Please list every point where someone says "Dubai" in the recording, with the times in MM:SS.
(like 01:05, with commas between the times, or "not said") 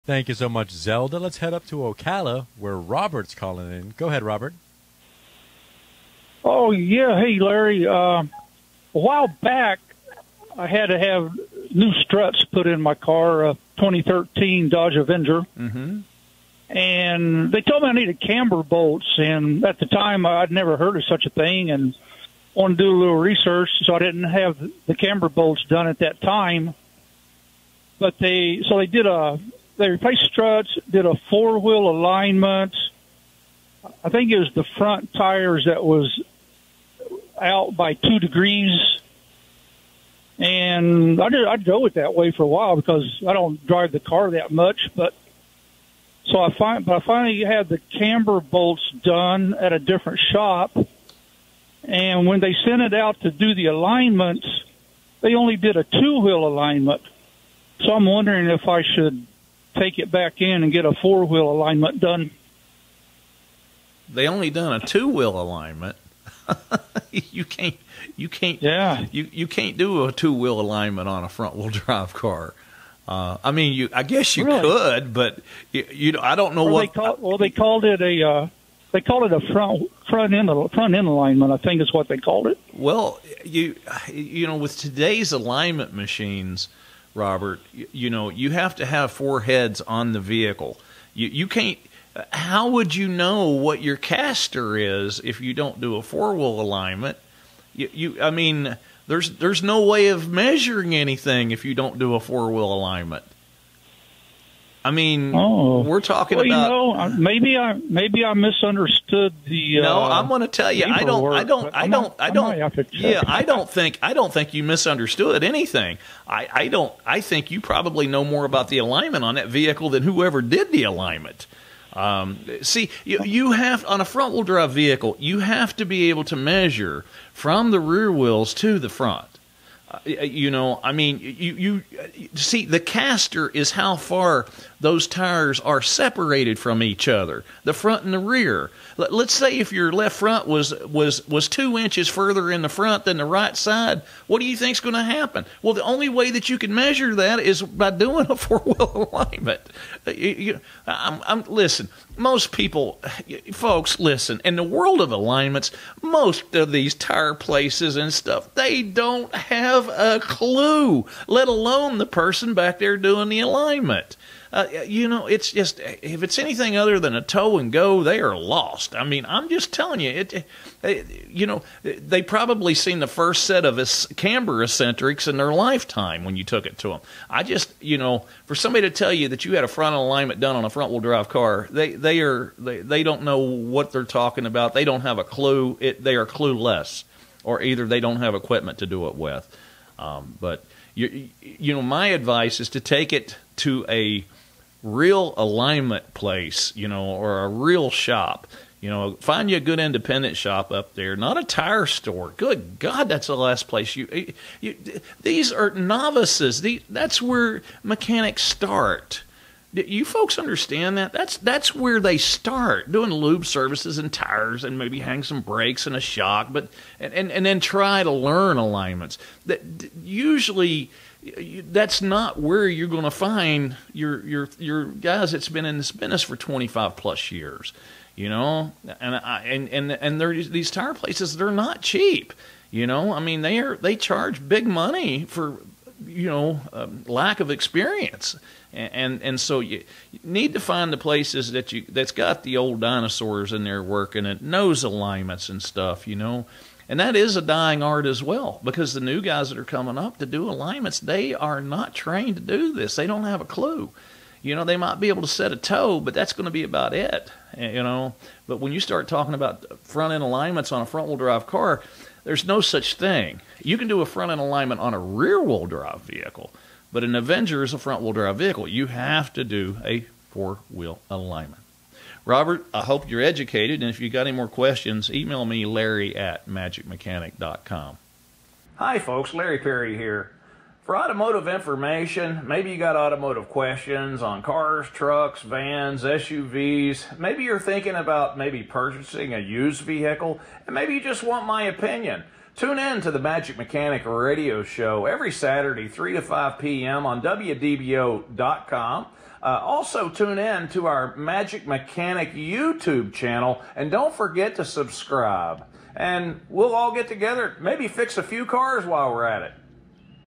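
not said.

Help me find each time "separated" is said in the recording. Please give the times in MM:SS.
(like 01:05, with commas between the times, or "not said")
02:15.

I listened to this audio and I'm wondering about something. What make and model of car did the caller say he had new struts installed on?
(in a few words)
2013 Dodge Avenger.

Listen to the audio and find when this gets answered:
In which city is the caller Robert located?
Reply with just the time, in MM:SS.
00:01.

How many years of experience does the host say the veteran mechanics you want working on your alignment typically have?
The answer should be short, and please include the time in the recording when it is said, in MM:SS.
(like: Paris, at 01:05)
25 plus years, at 03:46.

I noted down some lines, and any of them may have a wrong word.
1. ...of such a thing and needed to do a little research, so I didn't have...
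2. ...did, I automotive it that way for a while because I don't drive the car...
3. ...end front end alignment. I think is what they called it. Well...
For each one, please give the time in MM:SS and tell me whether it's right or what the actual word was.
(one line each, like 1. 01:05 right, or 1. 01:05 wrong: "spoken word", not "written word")
1. 00:20 wrong: "wanted", not "needed"
2. 00:41 wrong: "drove", not "automotive"
3. 01:20 right.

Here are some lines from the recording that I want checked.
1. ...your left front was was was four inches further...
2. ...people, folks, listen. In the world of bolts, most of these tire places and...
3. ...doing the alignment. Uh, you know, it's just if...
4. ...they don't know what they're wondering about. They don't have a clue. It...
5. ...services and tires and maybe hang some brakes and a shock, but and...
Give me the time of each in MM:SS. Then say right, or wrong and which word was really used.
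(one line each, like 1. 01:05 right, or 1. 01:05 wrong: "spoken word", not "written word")
1. 02:19 wrong: "two", not "four"
2. 02:32 wrong: "alignments", not "bolts"
3. 02:42 right
4. 03:02 wrong: "talking", not "wondering"
5. 03:33 right.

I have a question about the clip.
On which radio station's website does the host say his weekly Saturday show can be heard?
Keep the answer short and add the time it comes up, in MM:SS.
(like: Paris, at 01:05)
WDBO.com, at 04:57.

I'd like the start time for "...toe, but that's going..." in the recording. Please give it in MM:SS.
04:15.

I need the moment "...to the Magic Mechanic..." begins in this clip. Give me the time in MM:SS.
04:53.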